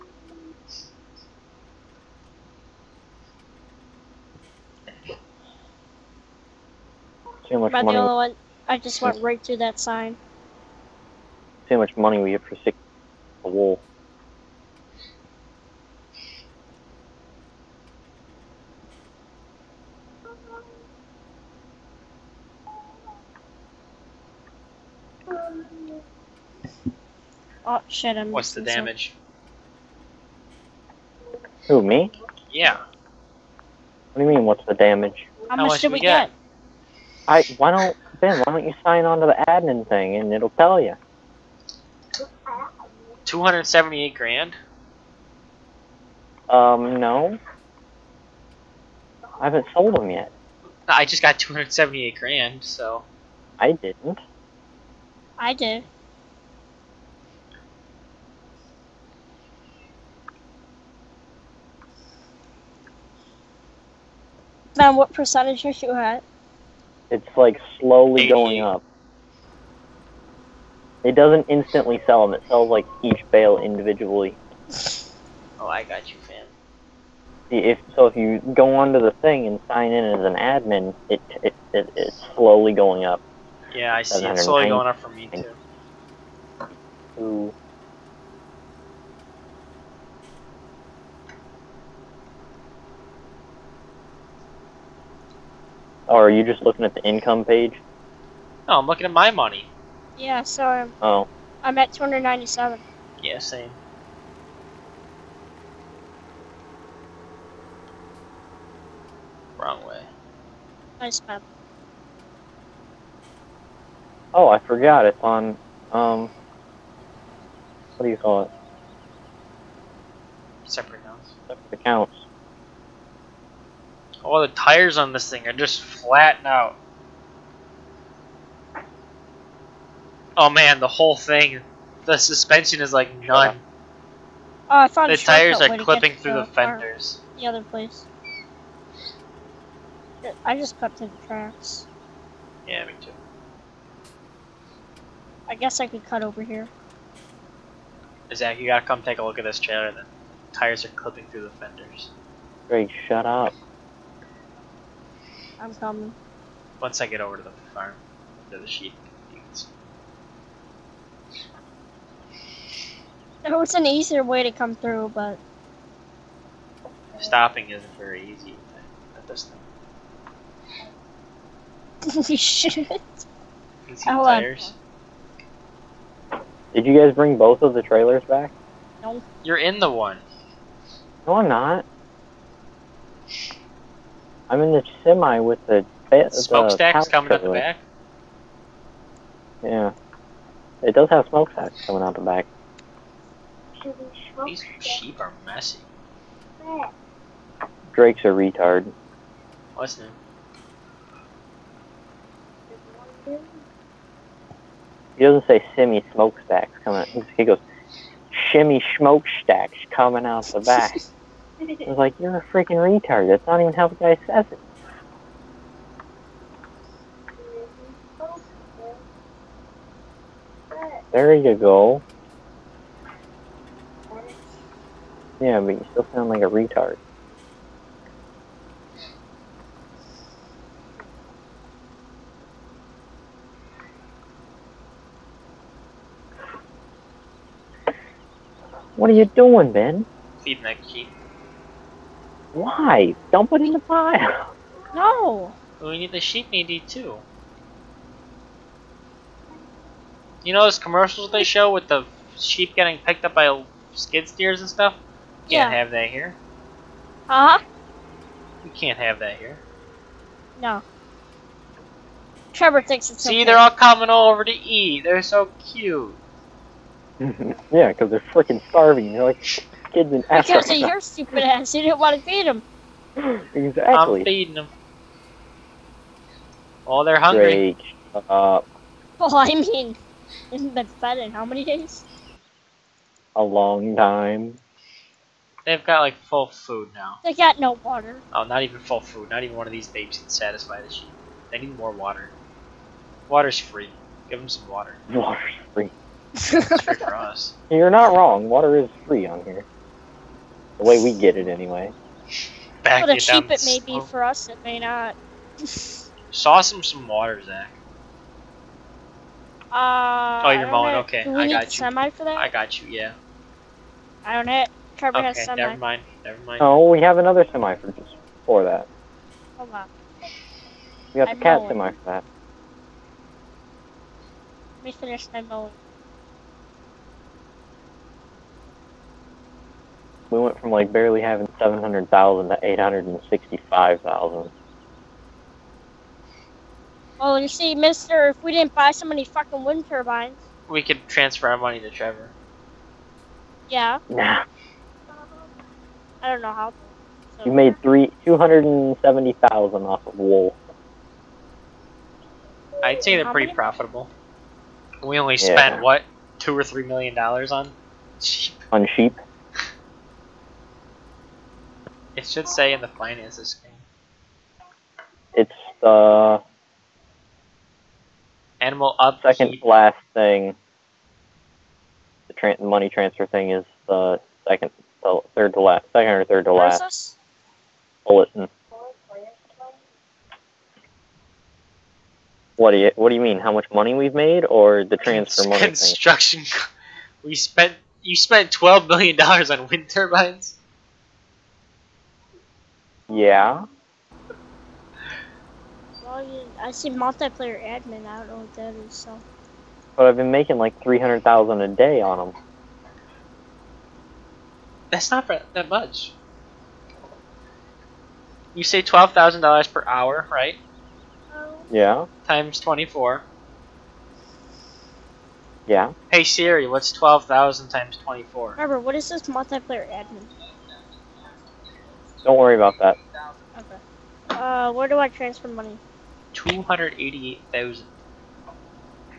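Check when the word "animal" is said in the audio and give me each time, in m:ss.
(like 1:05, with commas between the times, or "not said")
6:08.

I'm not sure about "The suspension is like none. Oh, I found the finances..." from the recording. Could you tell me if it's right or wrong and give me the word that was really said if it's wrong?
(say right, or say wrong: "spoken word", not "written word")
wrong: "tires", not "finances".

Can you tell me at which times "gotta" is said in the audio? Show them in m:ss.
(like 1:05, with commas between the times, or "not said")
2:28.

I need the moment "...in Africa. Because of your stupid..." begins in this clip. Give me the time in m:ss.
4:30.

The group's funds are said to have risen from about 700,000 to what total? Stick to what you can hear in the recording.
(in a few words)
865,000.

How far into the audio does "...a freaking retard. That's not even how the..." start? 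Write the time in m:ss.
3:32.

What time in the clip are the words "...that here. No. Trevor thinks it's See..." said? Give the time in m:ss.
4:19.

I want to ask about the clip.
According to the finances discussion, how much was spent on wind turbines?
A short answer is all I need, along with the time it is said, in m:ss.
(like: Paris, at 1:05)
12 million dollars, at 6:28.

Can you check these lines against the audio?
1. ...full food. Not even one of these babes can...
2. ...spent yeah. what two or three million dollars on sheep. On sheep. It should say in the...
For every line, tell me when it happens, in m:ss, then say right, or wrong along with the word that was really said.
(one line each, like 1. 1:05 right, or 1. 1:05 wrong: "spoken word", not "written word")
1. 4:48 right
2. 5:55 right.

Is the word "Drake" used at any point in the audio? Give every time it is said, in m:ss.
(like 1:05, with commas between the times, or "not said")
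3:17, 4:37.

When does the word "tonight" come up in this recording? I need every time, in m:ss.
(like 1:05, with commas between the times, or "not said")
not said.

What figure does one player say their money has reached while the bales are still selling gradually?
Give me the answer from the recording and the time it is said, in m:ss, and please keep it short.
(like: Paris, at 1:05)
297, at 1:41.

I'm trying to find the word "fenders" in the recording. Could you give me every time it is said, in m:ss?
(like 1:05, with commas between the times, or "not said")
2:16, 2:31.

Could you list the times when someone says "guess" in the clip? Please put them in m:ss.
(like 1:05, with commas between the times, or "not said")
2:25.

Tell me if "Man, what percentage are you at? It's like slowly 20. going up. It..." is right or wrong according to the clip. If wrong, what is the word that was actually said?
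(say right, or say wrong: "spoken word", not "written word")
wrong: "80", not "20".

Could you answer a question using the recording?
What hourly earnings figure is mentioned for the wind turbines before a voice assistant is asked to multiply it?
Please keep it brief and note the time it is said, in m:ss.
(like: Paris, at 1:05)
12,000 dollars, at 6:48.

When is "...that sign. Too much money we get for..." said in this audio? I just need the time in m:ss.
0:09.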